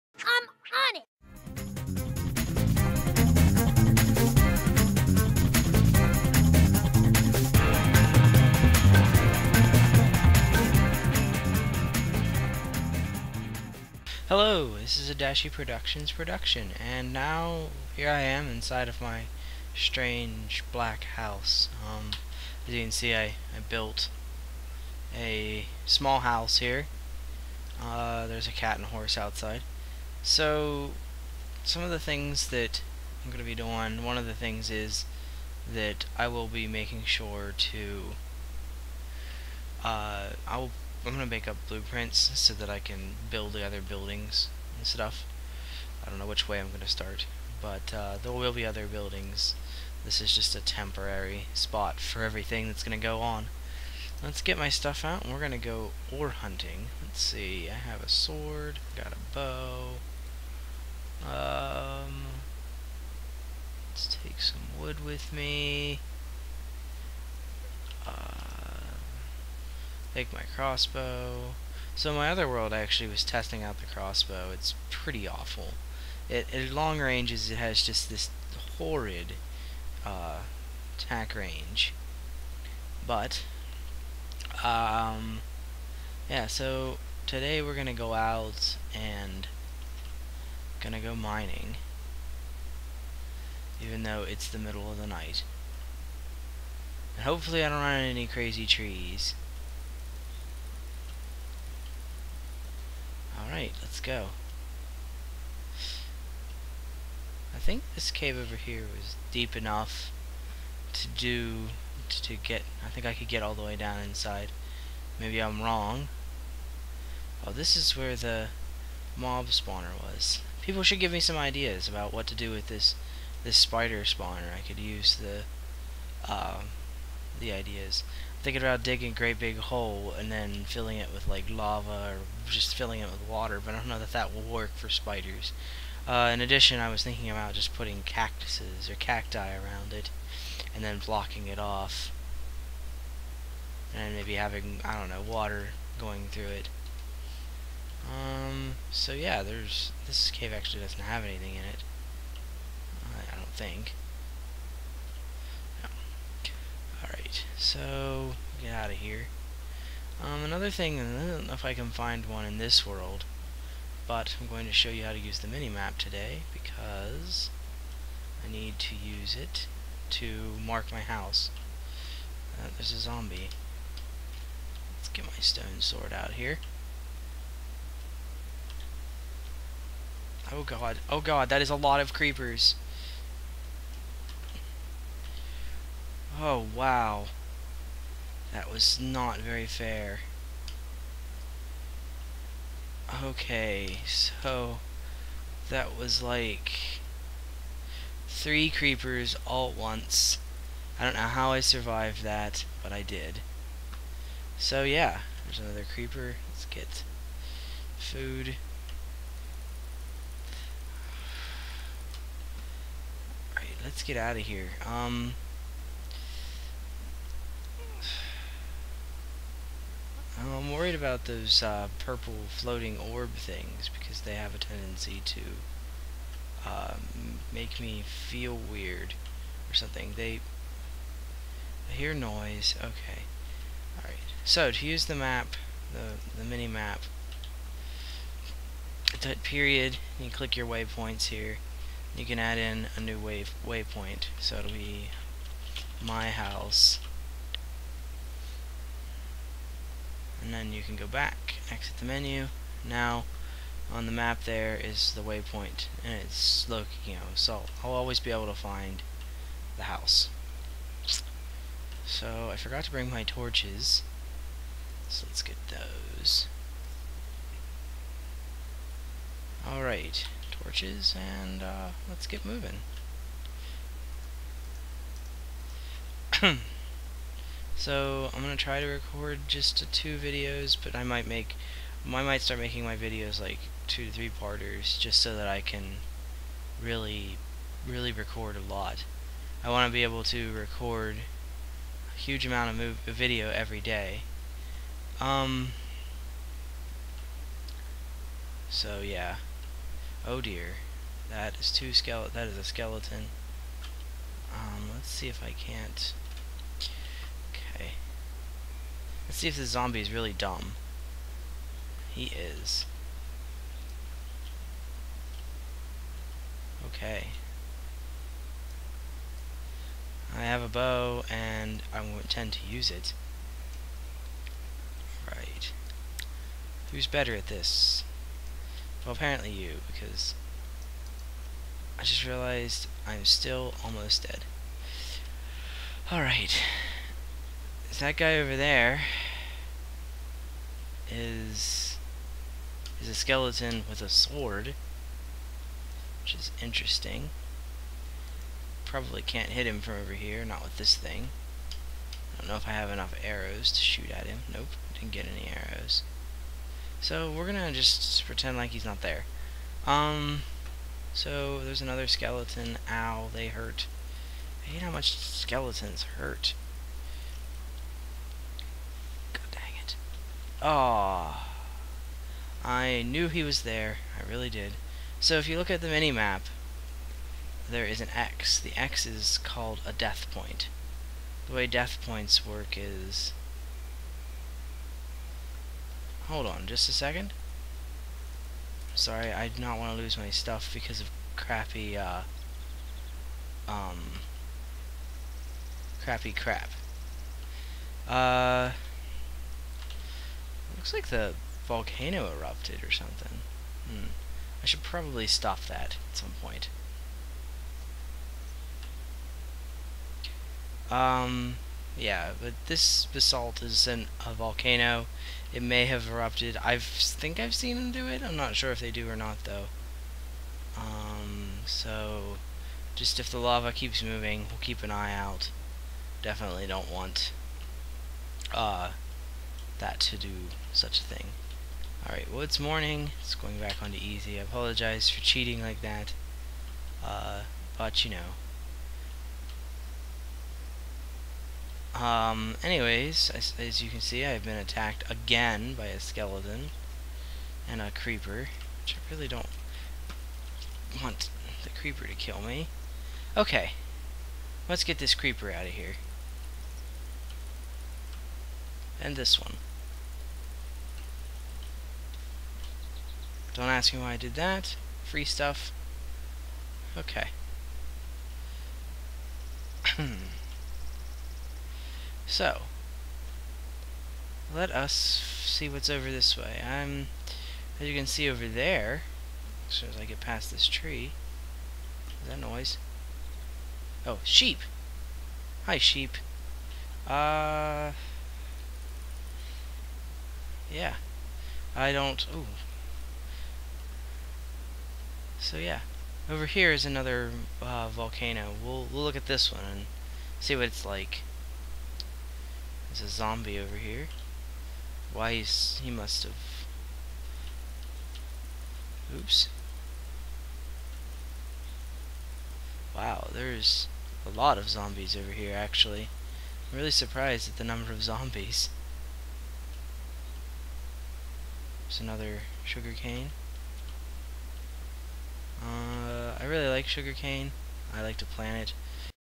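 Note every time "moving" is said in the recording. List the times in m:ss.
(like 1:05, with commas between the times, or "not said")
4:32, 7:04.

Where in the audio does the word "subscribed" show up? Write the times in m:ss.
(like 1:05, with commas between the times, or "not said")
not said.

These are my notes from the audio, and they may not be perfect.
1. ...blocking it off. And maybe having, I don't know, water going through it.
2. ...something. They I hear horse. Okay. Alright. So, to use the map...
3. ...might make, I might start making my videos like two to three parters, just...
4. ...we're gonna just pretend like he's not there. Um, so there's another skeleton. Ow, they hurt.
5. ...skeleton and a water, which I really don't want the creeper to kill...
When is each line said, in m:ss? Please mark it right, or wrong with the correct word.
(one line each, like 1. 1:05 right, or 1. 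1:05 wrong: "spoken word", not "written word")
1. 2:21 right
2. 3:49 wrong: "noise", not "horse"
3. 4:41 right
4. 5:57 right
5. 7:25 wrong: "creeper", not "water".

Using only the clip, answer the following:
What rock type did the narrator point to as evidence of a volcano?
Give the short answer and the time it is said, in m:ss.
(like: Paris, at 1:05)
Basalt, at 6:53.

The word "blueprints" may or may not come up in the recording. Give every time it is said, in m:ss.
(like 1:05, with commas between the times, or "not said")
0:41.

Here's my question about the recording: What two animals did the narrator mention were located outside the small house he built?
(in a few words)
A cat and a horse.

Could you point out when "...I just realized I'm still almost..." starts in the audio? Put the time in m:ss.
5:31.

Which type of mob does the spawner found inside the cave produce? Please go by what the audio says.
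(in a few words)
Spider.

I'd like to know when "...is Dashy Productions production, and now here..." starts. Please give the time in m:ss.
0:14.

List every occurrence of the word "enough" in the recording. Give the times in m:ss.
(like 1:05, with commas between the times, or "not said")
1:49, 5:52.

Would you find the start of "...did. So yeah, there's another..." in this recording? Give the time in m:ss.
3:23.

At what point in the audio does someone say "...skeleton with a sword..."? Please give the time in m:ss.
5:43.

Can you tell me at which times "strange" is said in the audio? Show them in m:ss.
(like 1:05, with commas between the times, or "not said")
0:19.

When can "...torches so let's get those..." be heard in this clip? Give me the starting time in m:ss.
4:23.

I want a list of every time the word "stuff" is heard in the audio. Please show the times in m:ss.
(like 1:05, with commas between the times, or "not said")
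0:44, 0:54, 6:30, 7:45.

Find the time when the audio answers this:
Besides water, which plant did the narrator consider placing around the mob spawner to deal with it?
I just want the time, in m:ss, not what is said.
2:18.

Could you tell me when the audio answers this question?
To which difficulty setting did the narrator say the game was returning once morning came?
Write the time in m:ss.
7:13.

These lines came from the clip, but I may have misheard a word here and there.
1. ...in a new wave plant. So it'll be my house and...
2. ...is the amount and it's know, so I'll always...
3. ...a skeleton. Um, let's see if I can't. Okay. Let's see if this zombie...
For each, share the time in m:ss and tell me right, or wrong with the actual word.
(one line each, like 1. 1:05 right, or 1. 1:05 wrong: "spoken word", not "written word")
1. 4:02 wrong: "waypoint", not "plant"
2. 4:14 wrong: "waypoint", not "amount"
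3. 5:02 right.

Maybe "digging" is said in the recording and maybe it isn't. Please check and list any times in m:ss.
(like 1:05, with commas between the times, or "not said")
2:08.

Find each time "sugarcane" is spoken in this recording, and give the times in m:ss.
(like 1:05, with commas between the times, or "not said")
8:42, 8:46.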